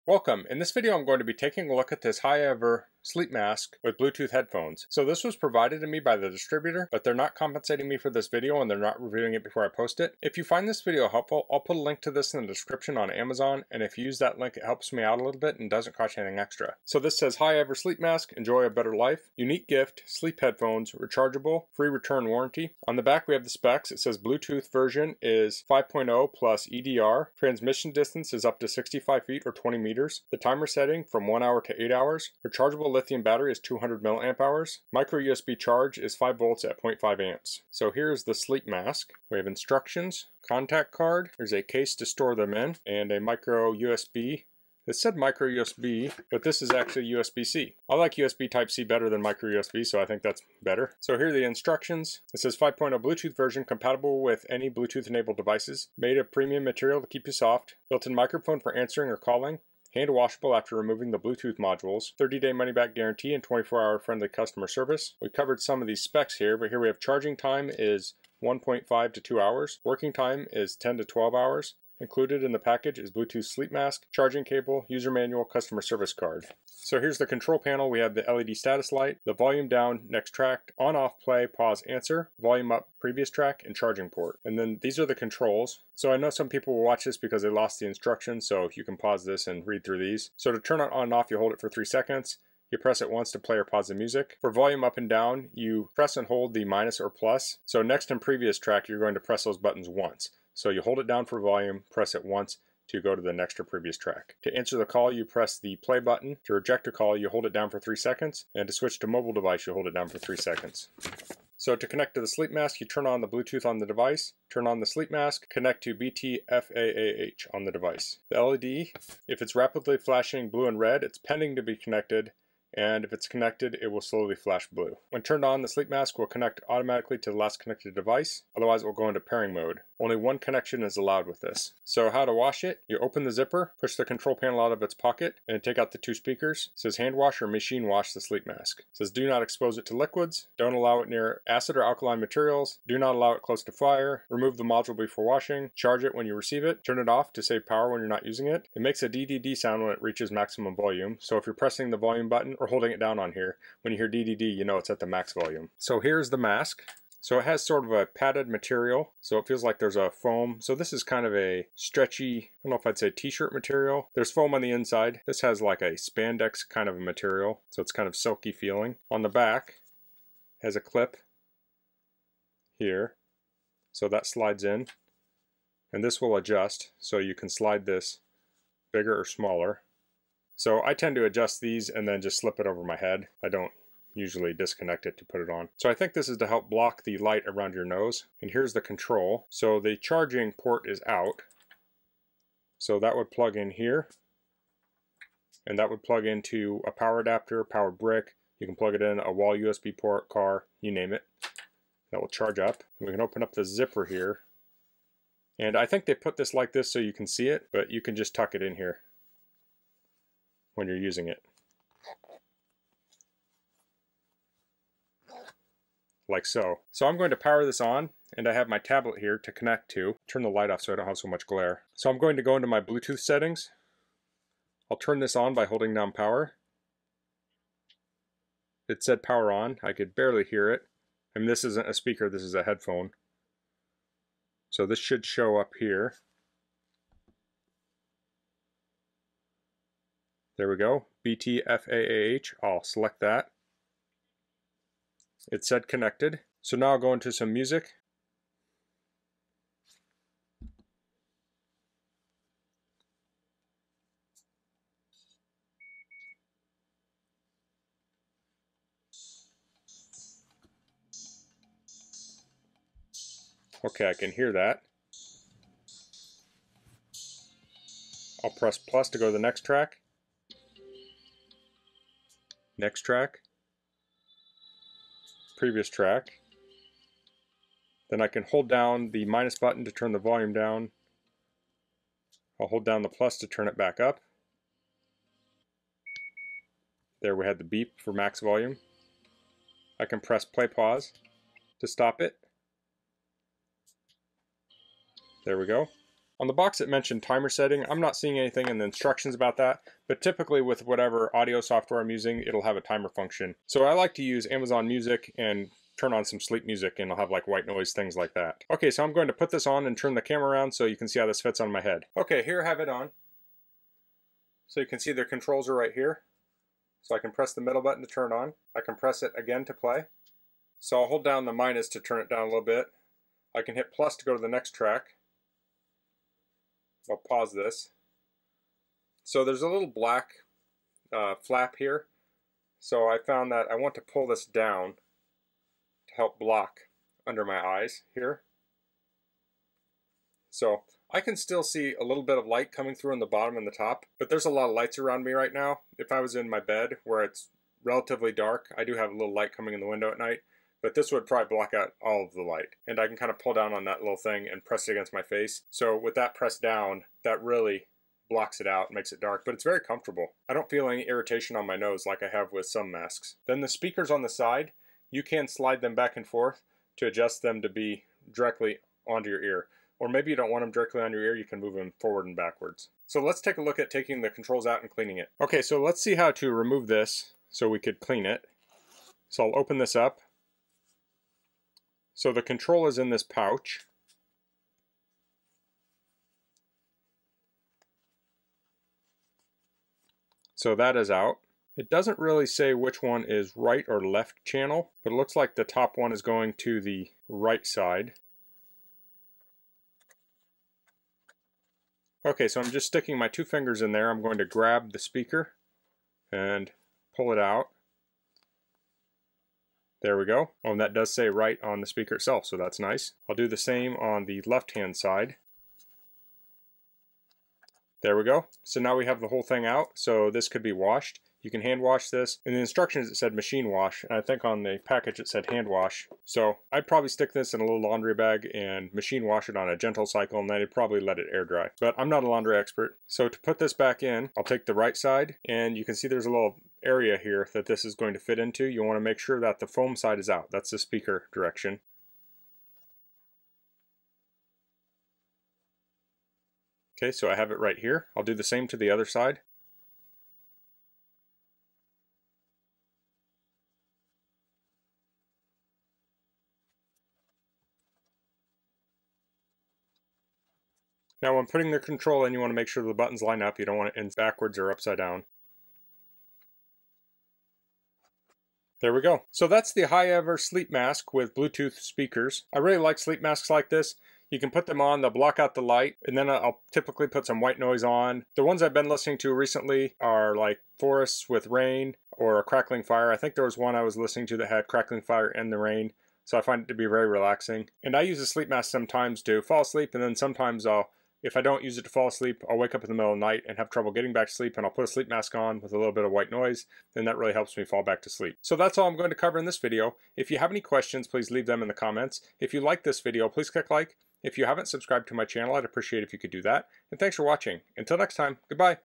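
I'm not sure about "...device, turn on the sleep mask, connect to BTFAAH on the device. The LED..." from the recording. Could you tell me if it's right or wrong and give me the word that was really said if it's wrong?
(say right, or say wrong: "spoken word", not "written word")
right.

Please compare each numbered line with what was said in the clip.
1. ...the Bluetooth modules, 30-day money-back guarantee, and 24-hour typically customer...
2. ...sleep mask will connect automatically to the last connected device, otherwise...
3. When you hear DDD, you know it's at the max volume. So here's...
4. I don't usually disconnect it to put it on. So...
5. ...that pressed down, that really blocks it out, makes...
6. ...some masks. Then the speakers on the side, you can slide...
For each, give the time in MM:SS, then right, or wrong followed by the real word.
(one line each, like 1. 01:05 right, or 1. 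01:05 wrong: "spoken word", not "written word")
1. 01:01 wrong: "friendly", not "typically"
2. 02:05 right
3. 02:33 right
4. 03:03 right
5. 05:56 right
6. 06:02 right.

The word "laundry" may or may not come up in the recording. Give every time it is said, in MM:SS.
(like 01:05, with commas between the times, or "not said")
07:07, 07:12.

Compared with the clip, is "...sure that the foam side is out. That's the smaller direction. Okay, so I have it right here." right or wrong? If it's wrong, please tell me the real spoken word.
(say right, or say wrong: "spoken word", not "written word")
wrong: "speaker", not "smaller".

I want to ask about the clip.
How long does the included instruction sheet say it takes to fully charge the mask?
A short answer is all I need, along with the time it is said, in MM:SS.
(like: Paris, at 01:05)
1.5 to 2 hours, at 01:08.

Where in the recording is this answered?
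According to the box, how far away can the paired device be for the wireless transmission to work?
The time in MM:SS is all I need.
00:28.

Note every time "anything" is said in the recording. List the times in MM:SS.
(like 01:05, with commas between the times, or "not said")
00:16, 04:58.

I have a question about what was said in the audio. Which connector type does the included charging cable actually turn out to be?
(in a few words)
USB-C.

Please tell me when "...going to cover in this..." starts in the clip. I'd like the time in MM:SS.
08:18.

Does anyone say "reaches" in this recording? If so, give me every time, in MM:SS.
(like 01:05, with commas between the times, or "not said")
02:30.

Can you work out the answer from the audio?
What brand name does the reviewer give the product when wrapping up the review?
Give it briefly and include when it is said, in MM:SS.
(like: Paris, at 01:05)
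HIGHEVER, at 07:49.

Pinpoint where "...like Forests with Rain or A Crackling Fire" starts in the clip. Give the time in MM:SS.
08:00.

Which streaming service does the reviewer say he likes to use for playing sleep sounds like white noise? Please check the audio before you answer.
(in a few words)
Amazon Music.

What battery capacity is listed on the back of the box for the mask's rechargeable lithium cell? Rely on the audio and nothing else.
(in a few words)
200 milliamp hours.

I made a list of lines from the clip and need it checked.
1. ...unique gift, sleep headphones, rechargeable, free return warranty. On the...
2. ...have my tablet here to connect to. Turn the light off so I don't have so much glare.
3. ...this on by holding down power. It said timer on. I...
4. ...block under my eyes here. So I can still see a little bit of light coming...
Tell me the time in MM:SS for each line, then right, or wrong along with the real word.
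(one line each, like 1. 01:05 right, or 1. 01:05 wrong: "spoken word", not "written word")
1. 00:19 right
2. 03:38 right
3. 03:45 wrong: "power", not "timer"
4. 05:36 right.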